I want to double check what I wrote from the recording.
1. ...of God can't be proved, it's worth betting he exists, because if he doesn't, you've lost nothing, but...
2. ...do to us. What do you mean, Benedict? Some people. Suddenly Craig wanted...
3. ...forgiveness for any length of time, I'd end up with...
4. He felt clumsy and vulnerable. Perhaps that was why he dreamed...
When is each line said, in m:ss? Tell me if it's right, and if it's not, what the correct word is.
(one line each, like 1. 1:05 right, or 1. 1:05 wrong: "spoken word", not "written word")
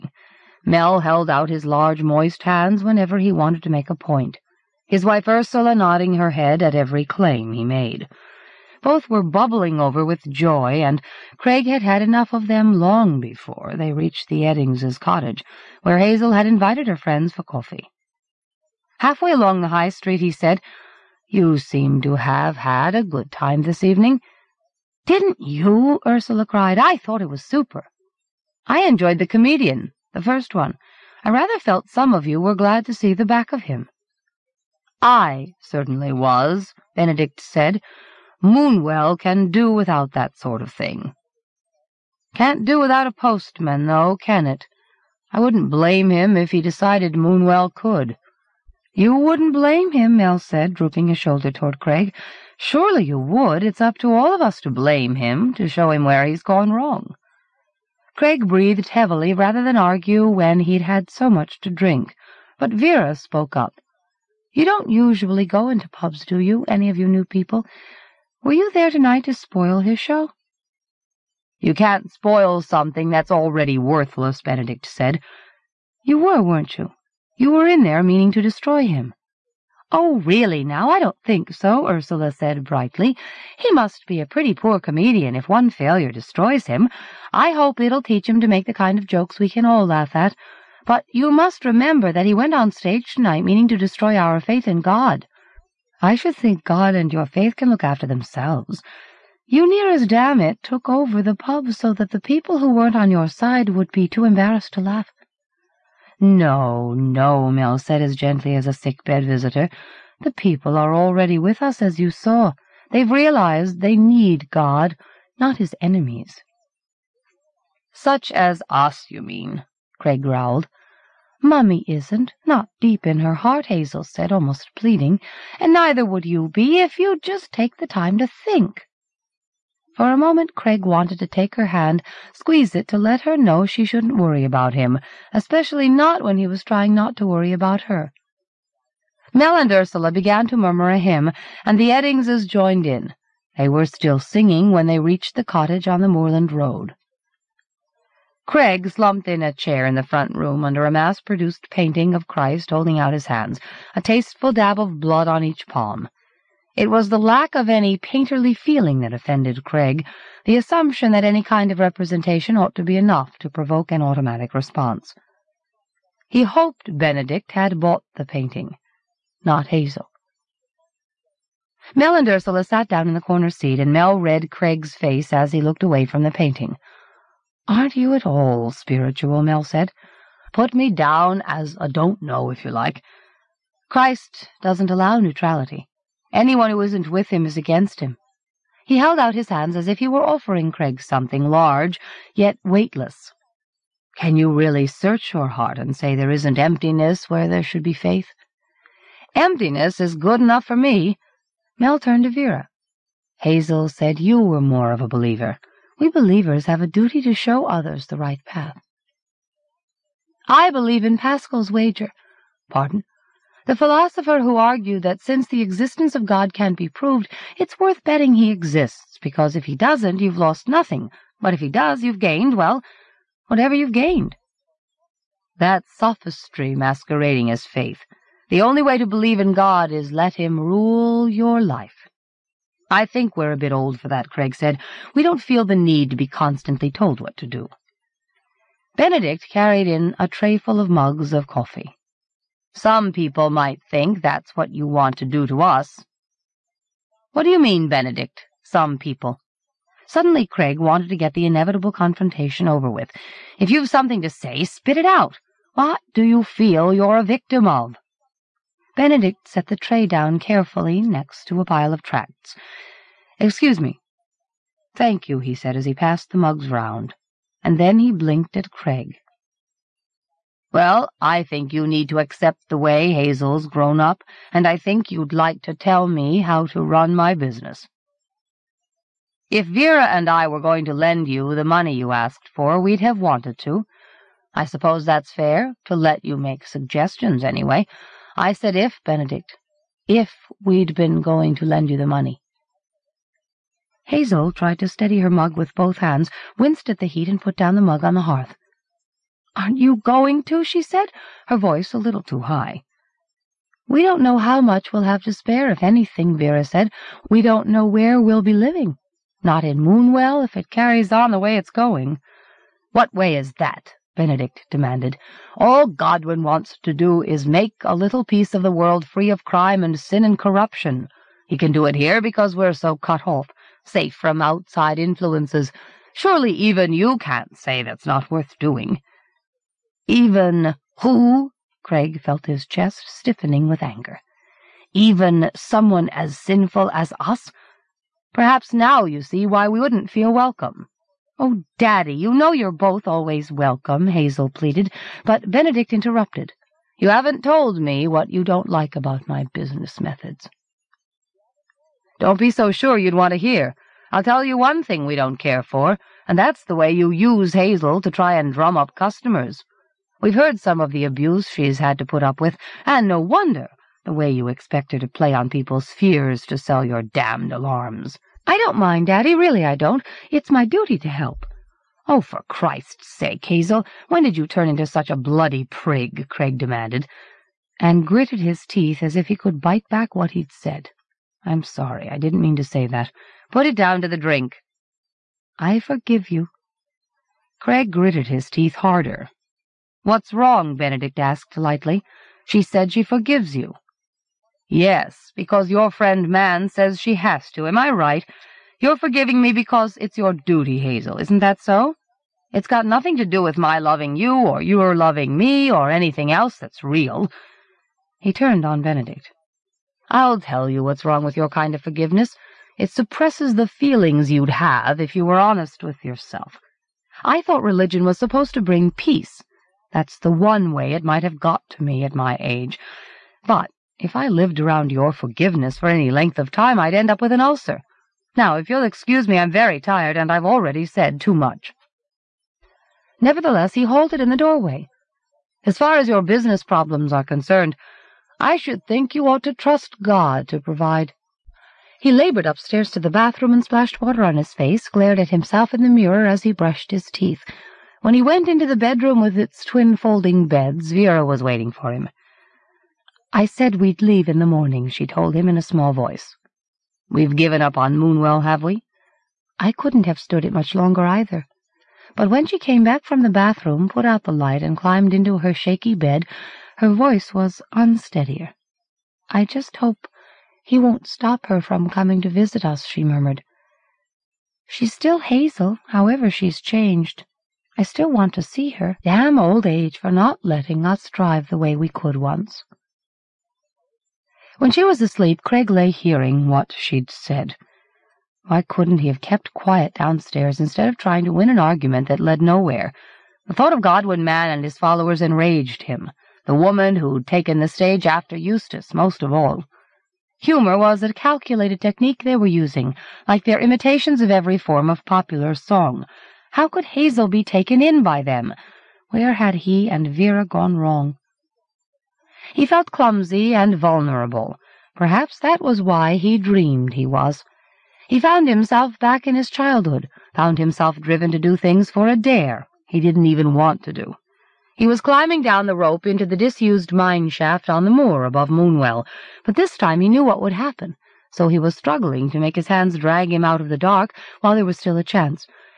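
1. 3:36 right
2. 4:05 right
3. 7:05 right
4. 8:32 right.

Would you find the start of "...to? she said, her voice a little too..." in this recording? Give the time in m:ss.
5:00.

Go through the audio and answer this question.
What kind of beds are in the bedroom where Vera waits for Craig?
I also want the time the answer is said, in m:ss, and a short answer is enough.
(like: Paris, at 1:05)
Twin folding beds, at 7:29.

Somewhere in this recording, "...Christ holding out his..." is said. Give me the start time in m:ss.
2:32.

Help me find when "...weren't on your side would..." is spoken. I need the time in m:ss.
1:42.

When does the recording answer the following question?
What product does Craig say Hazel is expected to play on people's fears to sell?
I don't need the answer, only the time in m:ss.
6:07.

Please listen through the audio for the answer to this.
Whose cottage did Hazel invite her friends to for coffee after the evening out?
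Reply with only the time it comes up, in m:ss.
0:14.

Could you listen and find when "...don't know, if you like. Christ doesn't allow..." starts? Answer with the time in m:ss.
3:01.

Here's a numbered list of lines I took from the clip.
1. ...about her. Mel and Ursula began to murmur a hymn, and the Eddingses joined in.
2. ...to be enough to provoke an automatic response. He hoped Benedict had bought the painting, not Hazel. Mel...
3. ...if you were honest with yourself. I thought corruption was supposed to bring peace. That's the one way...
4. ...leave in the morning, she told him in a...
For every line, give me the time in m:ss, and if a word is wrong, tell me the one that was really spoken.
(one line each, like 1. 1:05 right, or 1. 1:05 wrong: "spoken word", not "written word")
1. 2:17 right
2. 2:42 right
3. 6:54 wrong: "religion", not "corruption"
4. 7:33 right.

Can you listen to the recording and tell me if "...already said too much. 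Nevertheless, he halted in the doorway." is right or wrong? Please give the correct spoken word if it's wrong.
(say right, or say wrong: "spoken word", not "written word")
right.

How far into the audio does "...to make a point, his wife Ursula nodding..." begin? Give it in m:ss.
0:03.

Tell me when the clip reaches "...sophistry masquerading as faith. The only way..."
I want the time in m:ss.
3:45.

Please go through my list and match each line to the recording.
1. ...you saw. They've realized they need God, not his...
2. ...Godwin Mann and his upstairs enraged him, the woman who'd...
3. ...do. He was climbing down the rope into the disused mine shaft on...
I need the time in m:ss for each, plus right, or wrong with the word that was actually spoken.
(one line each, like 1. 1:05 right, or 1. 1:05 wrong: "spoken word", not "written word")
1. 1:51 right
2. 8:13 wrong: "followers", not "upstairs"
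3. 8:43 right.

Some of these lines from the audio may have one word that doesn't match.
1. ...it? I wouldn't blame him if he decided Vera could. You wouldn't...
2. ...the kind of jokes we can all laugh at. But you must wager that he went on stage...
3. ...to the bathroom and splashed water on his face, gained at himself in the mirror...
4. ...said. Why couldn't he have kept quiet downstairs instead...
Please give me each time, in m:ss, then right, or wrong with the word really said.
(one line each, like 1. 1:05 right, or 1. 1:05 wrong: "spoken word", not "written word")
1. 0:44 wrong: "Moonwell", not "Vera"
2. 1:28 wrong: "remember", not "wager"
3. 7:22 wrong: "glared", not "gained"
4. 8:07 right.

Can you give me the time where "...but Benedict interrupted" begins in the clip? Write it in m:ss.
5:45.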